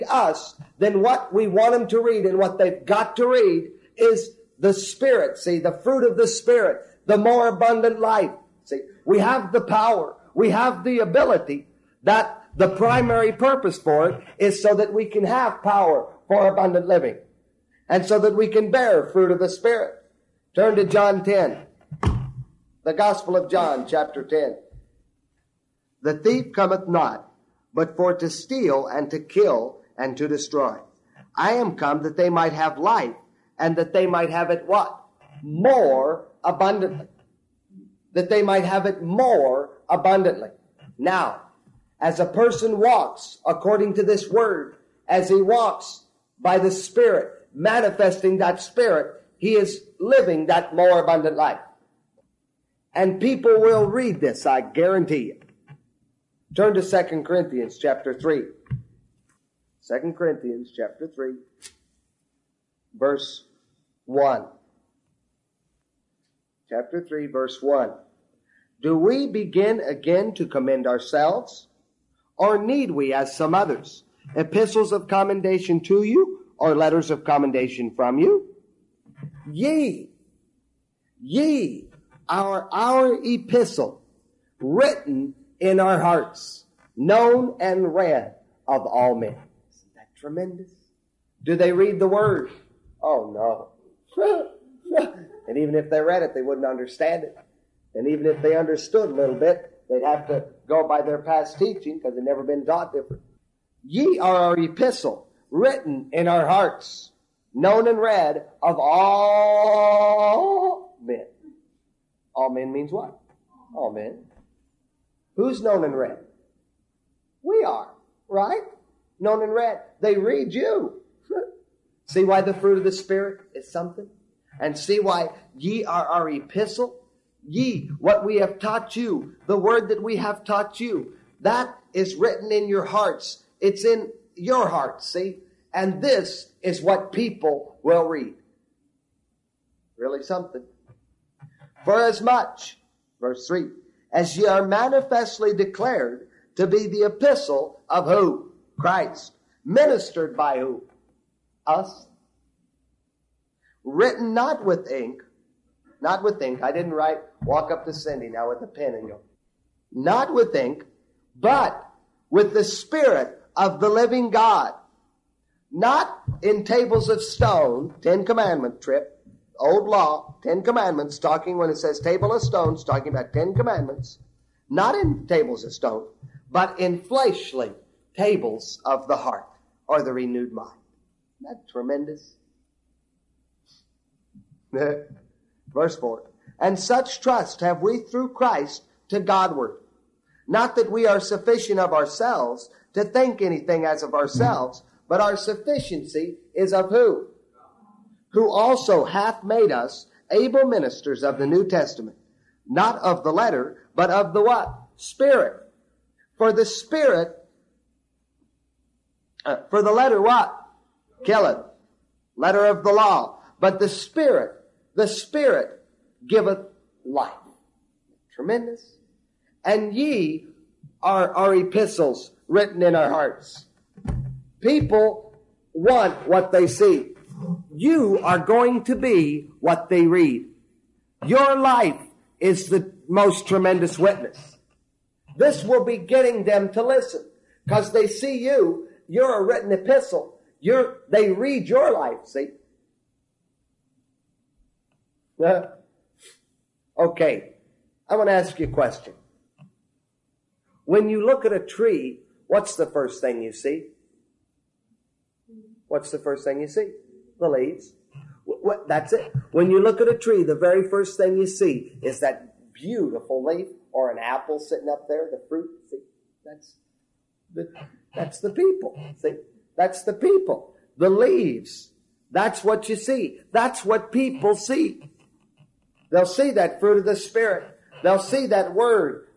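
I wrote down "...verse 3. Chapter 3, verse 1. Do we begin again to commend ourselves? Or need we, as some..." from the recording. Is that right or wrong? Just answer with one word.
wrong.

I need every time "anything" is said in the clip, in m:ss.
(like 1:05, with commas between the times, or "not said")
3:13.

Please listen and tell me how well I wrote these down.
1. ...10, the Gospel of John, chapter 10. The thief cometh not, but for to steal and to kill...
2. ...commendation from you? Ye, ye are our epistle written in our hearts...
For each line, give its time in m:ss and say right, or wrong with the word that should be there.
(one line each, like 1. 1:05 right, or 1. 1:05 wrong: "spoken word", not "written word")
1. 0:21 right
2. 1:17 right.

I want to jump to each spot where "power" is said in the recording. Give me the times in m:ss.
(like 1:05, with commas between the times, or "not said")
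0:09, 0:15.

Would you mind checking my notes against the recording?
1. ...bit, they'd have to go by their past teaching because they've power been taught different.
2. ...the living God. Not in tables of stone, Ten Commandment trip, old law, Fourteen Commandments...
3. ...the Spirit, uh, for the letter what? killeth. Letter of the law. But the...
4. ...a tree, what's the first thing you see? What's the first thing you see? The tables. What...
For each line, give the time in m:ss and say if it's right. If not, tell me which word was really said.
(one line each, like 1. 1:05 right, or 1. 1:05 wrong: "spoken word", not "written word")
1. 1:39 wrong: "never", not "power"
2. 2:43 wrong: "Ten", not "Fourteen"
3. 3:26 right
4. 4:11 wrong: "leaves", not "tables".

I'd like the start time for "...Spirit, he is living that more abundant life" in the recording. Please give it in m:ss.
0:48.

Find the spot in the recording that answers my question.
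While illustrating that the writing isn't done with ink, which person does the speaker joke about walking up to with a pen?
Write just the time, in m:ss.
2:37.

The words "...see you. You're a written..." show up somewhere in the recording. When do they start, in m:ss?
3:58.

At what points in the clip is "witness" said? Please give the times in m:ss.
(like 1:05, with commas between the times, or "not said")
3:53.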